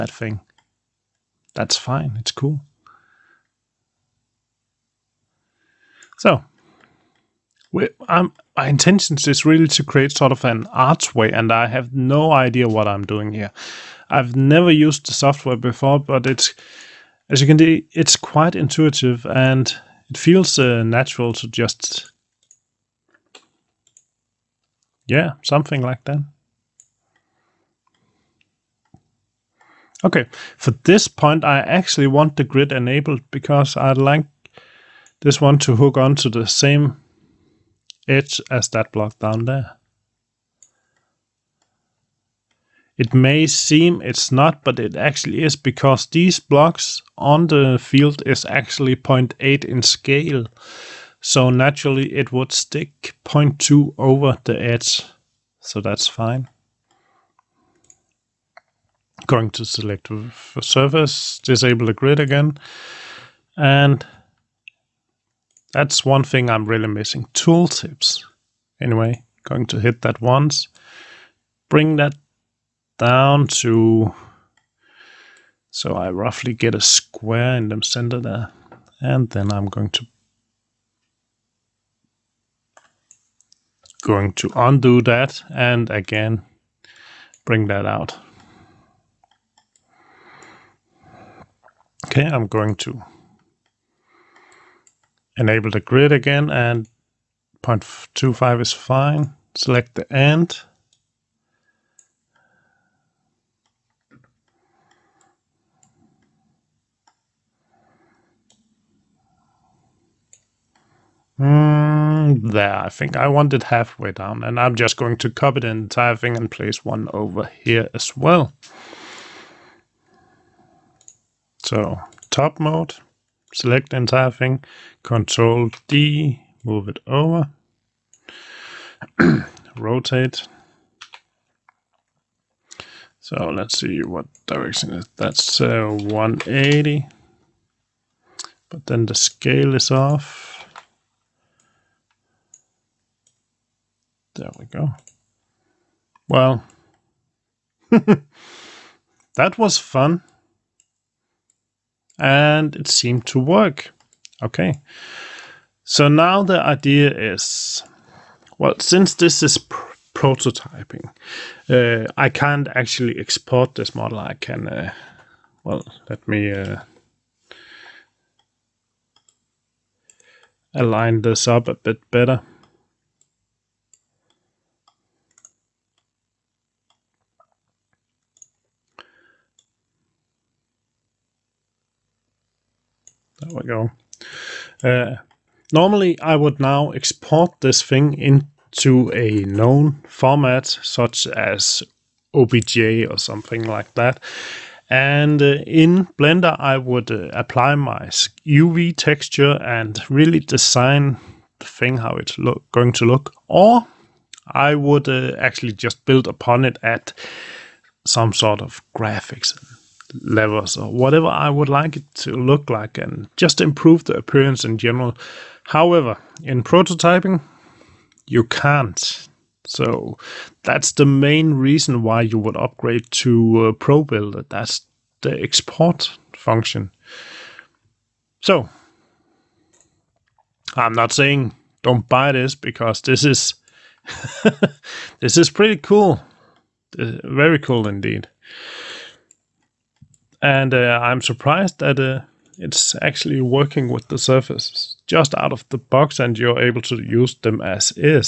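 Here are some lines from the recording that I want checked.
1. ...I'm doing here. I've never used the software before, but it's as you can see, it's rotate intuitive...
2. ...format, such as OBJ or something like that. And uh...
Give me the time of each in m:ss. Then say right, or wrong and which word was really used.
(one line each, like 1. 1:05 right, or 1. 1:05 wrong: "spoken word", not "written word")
1. 0:12 wrong: "quite", not "rotate"
2. 3:10 right.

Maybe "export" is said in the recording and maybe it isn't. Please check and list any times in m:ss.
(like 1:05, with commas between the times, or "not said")
2:43, 3:06, 3:45.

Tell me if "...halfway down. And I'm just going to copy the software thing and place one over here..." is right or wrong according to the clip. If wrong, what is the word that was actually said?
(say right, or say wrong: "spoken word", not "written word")
wrong: "entire", not "software".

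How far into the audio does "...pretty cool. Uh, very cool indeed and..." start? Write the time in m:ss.
3:55.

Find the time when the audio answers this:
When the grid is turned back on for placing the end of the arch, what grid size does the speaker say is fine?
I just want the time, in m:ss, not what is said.
1:37.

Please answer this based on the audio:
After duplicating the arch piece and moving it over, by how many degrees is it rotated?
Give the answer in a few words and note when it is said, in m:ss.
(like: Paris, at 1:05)
180, at 2:15.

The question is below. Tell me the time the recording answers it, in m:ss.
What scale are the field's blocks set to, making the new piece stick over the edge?
0:48.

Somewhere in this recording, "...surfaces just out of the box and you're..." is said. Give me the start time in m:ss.
4:04.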